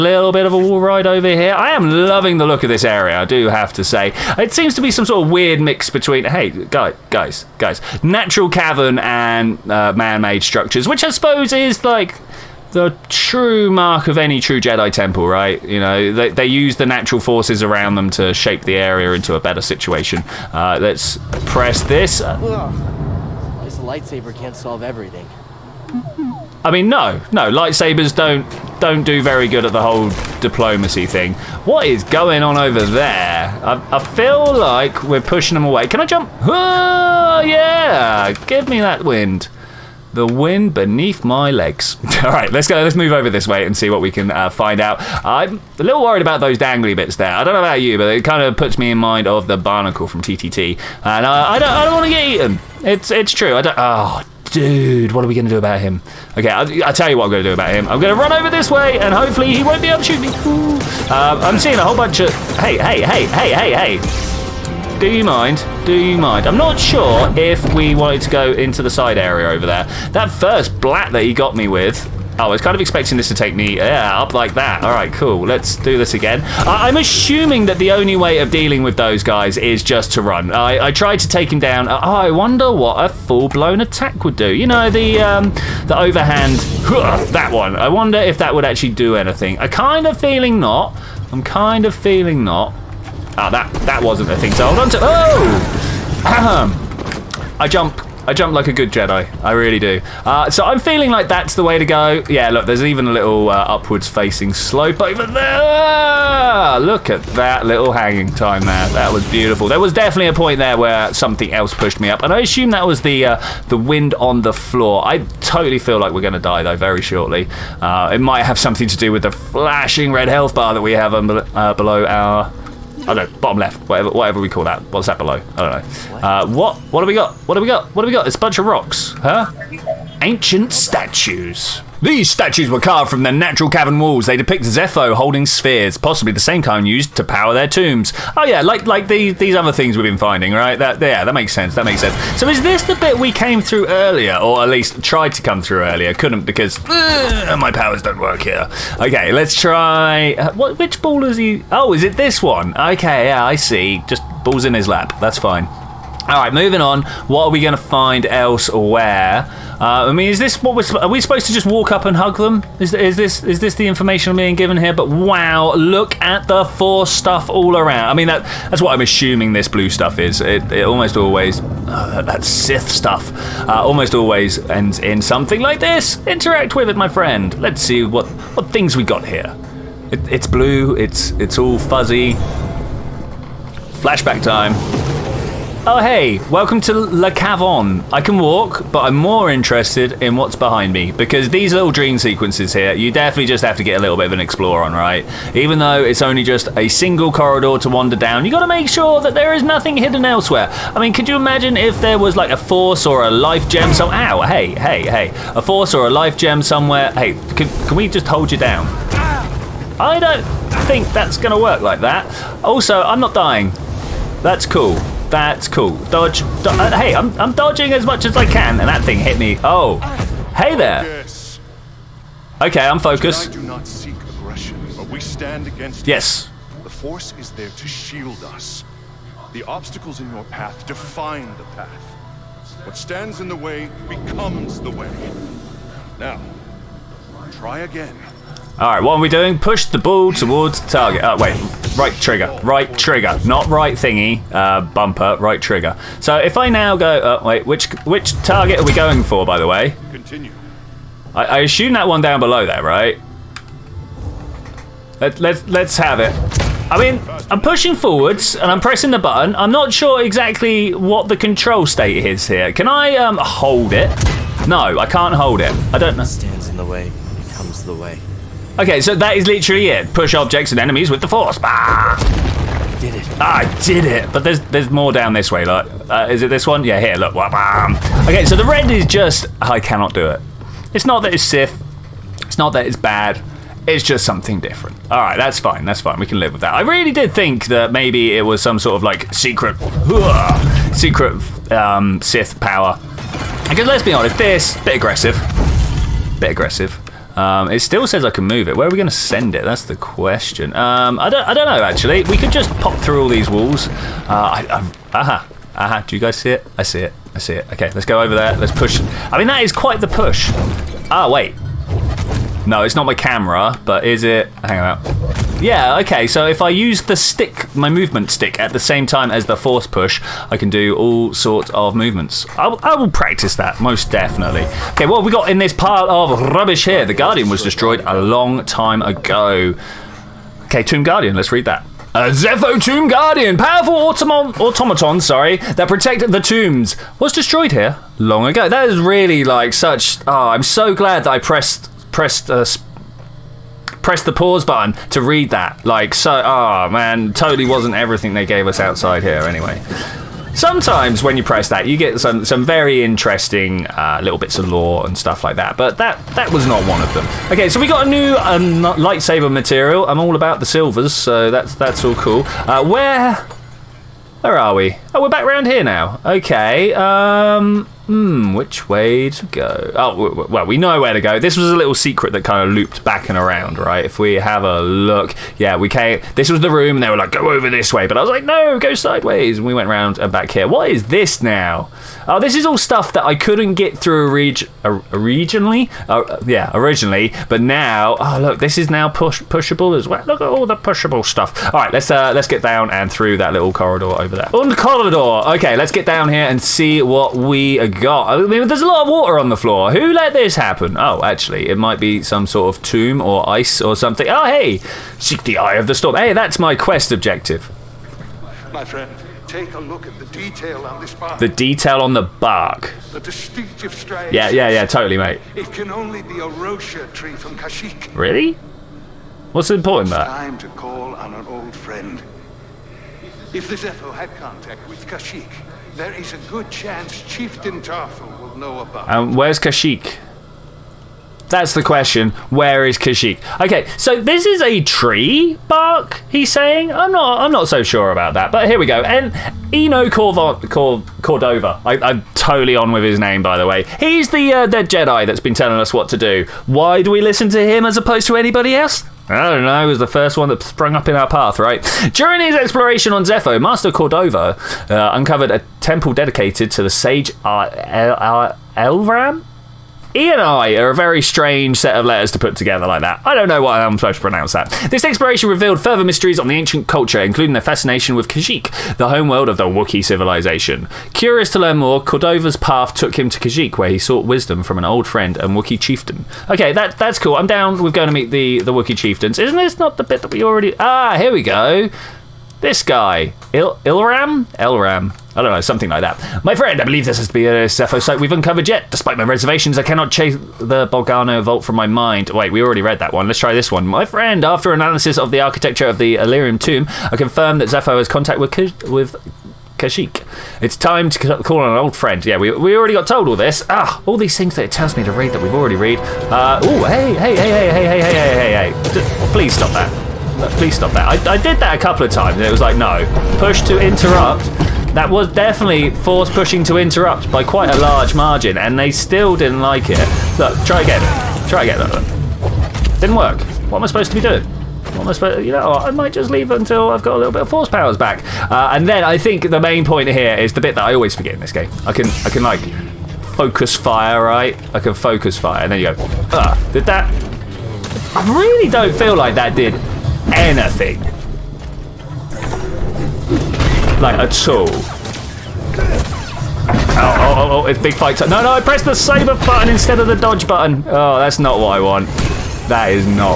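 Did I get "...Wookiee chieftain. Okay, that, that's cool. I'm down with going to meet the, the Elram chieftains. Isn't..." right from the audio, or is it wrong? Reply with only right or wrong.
wrong.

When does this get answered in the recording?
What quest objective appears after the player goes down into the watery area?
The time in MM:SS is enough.
06:45.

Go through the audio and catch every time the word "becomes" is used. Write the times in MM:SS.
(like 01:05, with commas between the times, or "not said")
03:54.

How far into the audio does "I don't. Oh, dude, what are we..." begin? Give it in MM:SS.
00:53.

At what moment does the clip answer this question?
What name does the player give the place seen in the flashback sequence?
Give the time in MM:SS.
03:06.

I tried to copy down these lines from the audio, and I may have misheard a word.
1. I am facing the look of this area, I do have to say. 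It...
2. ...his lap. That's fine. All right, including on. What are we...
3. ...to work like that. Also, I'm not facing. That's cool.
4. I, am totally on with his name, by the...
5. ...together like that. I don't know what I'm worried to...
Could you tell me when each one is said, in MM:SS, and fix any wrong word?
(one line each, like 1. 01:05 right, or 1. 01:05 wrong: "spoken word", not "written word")
1. 00:01 wrong: "loving", not "facing"
2. 02:34 wrong: "moving", not "including"
3. 03:31 wrong: "dying", not "facing"
4. 07:21 right
5. 07:42 wrong: "supposed", not "worried".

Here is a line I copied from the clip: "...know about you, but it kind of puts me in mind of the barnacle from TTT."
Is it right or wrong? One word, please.
right.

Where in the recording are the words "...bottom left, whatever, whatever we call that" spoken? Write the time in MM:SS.
02:03.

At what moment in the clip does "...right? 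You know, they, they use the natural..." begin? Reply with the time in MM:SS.
00:15.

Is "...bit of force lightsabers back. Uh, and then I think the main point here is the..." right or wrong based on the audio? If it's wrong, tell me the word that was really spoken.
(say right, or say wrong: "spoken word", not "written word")
wrong: "powers", not "lightsabers".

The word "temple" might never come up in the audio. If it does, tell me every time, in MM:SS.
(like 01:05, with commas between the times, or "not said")
00:14, 07:35.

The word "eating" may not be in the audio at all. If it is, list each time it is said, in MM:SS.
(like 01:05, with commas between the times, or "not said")
not said.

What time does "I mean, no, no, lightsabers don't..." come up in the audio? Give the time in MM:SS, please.
00:26.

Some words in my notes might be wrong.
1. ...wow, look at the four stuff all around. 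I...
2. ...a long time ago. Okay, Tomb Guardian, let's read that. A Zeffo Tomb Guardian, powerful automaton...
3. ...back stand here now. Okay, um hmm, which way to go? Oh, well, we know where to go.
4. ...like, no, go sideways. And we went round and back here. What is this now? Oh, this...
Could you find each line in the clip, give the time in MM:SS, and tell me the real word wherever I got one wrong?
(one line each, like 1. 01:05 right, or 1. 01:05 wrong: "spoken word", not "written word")
1. 02:45 right
2. 05:28 right
3. 06:05 wrong: "round", not "stand"
4. 06:18 right.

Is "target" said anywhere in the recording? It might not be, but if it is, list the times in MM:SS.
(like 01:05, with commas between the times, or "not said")
04:00, 04:08.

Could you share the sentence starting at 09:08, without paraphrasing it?
No, no, I pressed the saber button instead of the dodge button.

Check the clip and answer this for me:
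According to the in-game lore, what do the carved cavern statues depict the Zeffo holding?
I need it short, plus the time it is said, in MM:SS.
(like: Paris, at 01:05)
Spheres, at 02:15.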